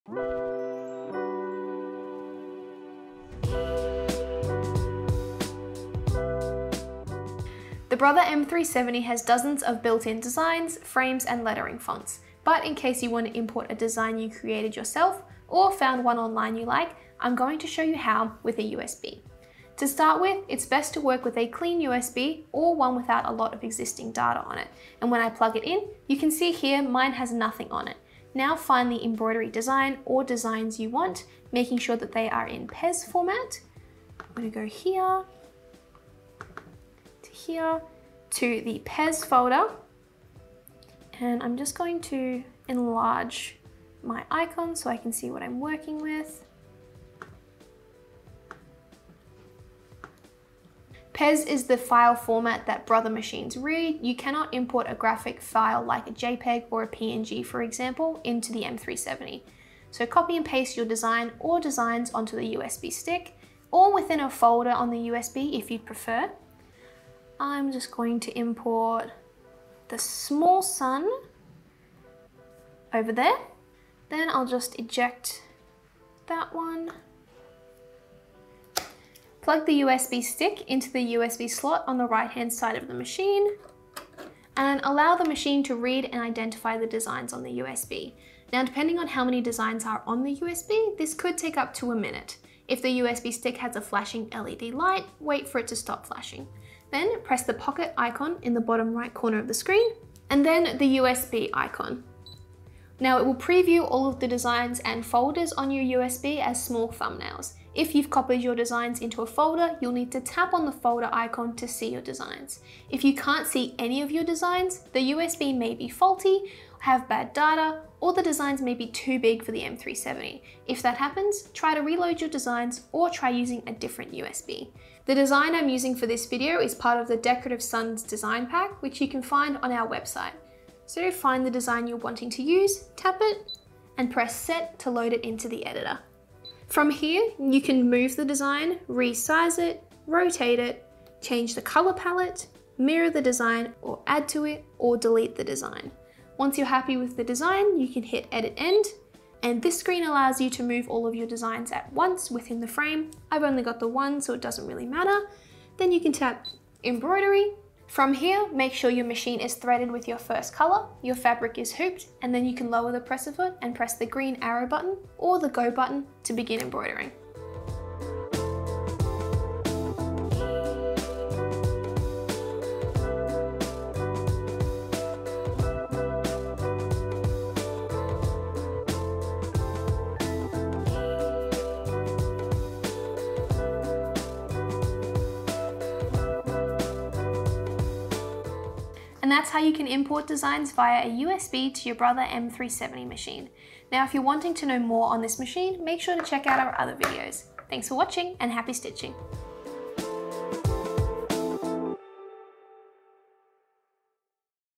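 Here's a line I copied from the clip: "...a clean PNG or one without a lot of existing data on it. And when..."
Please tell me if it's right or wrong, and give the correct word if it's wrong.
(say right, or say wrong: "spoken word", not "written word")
wrong: "USB", not "PNG".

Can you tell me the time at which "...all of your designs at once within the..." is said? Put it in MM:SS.
02:30.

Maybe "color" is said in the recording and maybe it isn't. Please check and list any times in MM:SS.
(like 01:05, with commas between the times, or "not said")
02:21, 02:40.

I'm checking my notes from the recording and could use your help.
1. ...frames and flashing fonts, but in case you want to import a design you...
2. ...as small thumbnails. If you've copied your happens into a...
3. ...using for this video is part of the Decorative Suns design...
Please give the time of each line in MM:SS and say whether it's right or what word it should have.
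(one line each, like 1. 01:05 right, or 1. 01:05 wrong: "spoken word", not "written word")
1. 00:10 wrong: "lettering", not "flashing"
2. 01:46 wrong: "designs", not "happens"
3. 02:05 right.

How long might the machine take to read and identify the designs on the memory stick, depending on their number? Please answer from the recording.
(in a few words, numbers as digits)
up to a minute.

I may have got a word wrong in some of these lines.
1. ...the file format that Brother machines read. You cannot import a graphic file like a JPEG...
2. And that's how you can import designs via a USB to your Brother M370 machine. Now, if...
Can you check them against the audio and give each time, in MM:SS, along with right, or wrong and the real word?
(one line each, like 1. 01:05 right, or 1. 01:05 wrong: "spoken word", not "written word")
1. 00:51 right
2. 03:09 right.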